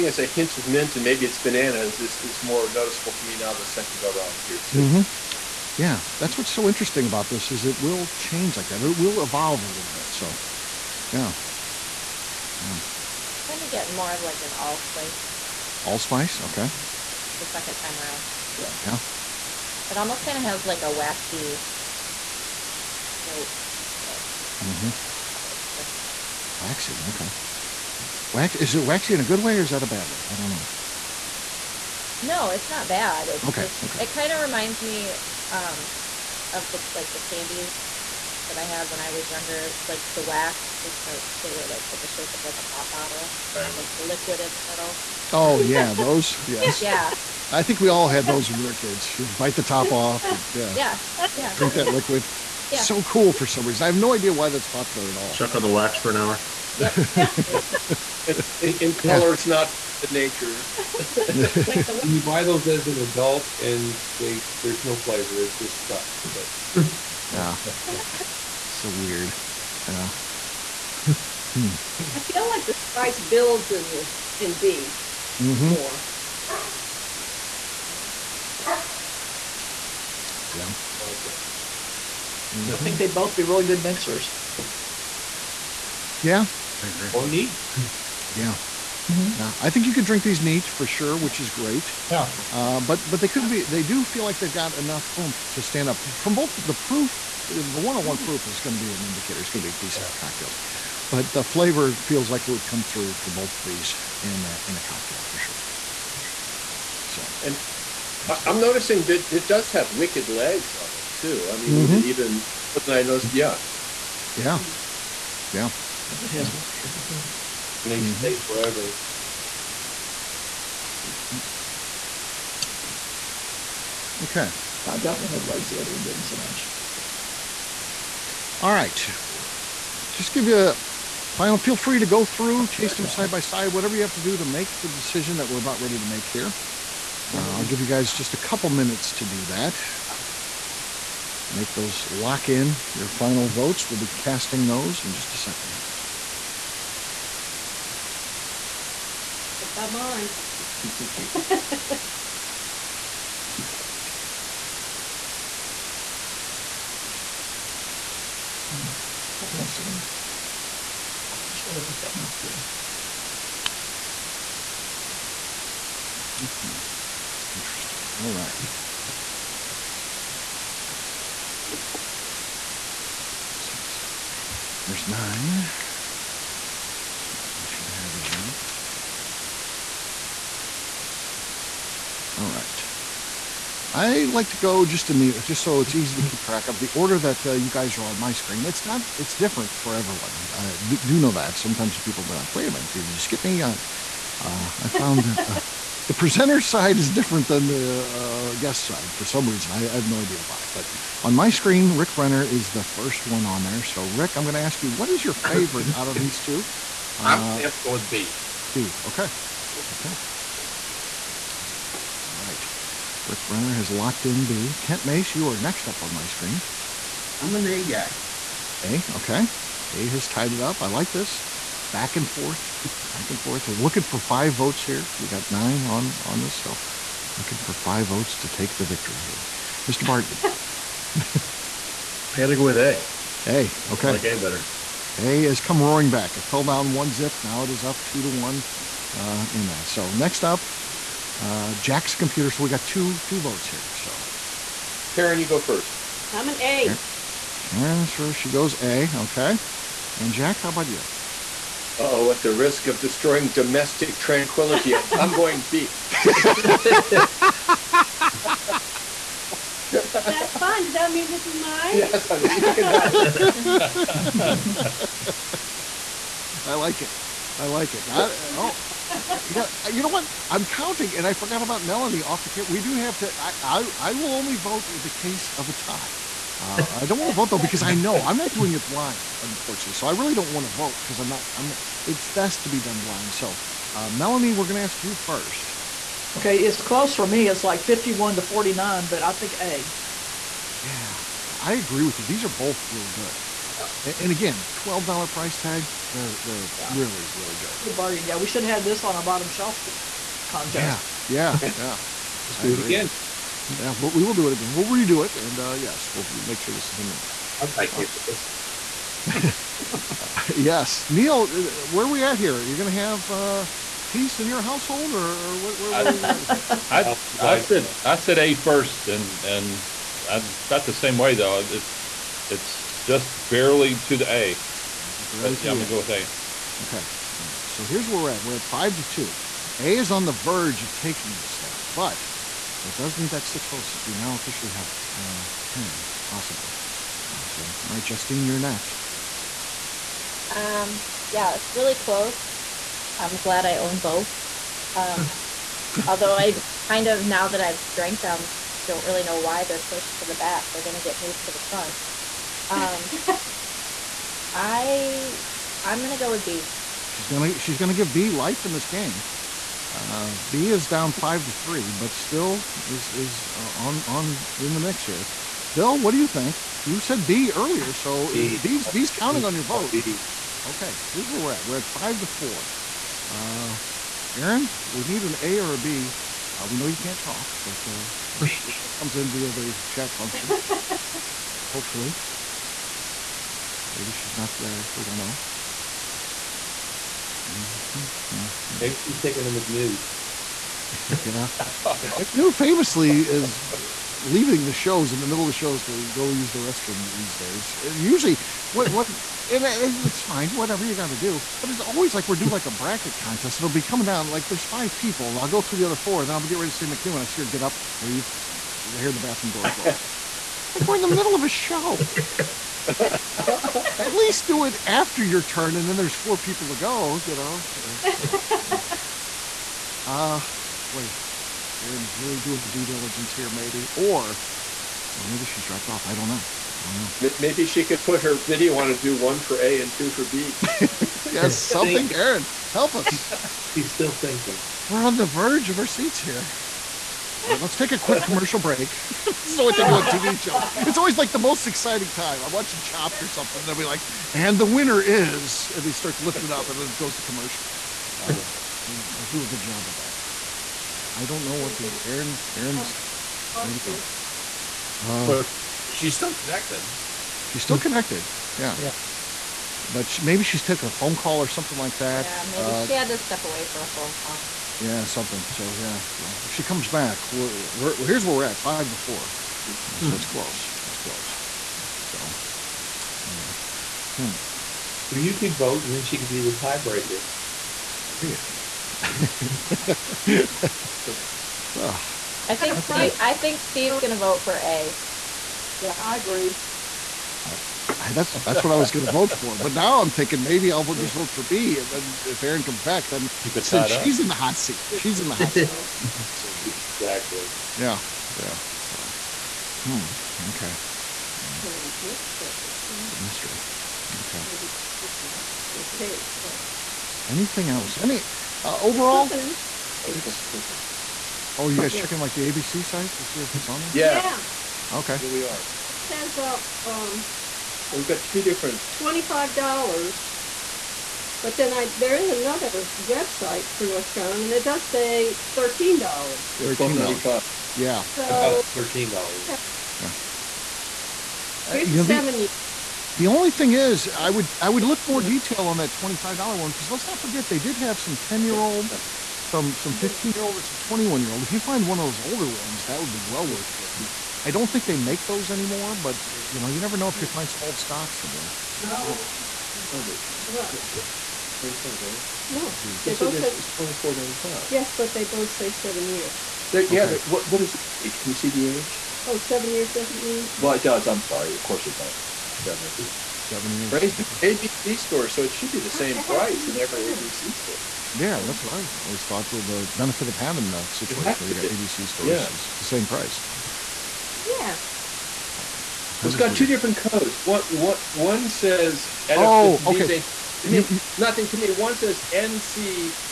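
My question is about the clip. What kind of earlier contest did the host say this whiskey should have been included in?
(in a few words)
bottom shelf contest.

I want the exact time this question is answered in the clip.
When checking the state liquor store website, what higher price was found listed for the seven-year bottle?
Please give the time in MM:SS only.
09:13.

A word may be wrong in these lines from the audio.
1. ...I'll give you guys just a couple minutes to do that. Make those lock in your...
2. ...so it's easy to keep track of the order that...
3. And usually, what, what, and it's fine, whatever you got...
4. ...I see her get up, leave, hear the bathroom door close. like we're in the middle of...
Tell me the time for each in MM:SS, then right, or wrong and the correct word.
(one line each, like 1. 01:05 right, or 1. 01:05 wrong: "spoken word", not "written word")
1. 02:17 right
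2. 03:05 right
3. 06:37 right
4. 06:47 right.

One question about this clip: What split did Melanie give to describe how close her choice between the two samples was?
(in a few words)
51 to 49.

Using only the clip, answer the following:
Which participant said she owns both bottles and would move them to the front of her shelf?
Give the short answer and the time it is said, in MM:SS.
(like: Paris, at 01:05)
Justine, at 05:38.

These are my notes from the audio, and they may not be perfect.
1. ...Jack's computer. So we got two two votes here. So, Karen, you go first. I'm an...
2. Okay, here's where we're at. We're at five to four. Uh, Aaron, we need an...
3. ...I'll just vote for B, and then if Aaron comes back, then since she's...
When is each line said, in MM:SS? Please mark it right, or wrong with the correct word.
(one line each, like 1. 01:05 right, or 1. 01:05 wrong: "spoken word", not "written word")
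1. 04:01 right
2. 06:10 right
3. 08:10 right.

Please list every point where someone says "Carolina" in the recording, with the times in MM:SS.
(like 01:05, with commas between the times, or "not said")
08:44.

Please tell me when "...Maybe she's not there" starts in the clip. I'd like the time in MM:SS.
06:23.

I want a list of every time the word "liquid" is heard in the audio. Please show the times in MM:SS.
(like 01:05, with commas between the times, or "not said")
00:44, 00:51.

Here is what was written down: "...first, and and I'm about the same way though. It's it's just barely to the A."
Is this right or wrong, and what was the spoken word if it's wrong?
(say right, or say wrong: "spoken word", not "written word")
right.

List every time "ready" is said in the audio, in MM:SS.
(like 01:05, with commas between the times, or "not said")
02:15, 06:46.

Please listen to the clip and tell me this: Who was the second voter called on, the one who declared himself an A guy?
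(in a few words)
Kent Mace.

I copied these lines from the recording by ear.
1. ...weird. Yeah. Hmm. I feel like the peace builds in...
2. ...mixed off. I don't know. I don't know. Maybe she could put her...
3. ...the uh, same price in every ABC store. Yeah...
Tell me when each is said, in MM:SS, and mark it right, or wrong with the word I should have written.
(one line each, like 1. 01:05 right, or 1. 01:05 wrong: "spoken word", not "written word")
1. 01:08 wrong: "spice", not "peace"
2. 07:05 wrong: "dropped", not "mixed"
3. 09:25 right.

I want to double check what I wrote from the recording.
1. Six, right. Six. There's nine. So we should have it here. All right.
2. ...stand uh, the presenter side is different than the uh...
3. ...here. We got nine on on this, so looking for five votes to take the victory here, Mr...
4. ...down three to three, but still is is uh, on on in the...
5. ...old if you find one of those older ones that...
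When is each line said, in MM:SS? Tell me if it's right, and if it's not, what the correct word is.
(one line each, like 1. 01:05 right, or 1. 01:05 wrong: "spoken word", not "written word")
1. 02:53 right
2. 03:14 wrong: "found", not "stand"
3. 03:44 right
4. 06:00 wrong: "five", not "three"
5. 09:01 right.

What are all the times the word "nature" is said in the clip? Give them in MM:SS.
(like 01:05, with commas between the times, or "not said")
01:00.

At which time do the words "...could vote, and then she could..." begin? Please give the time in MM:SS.
07:55.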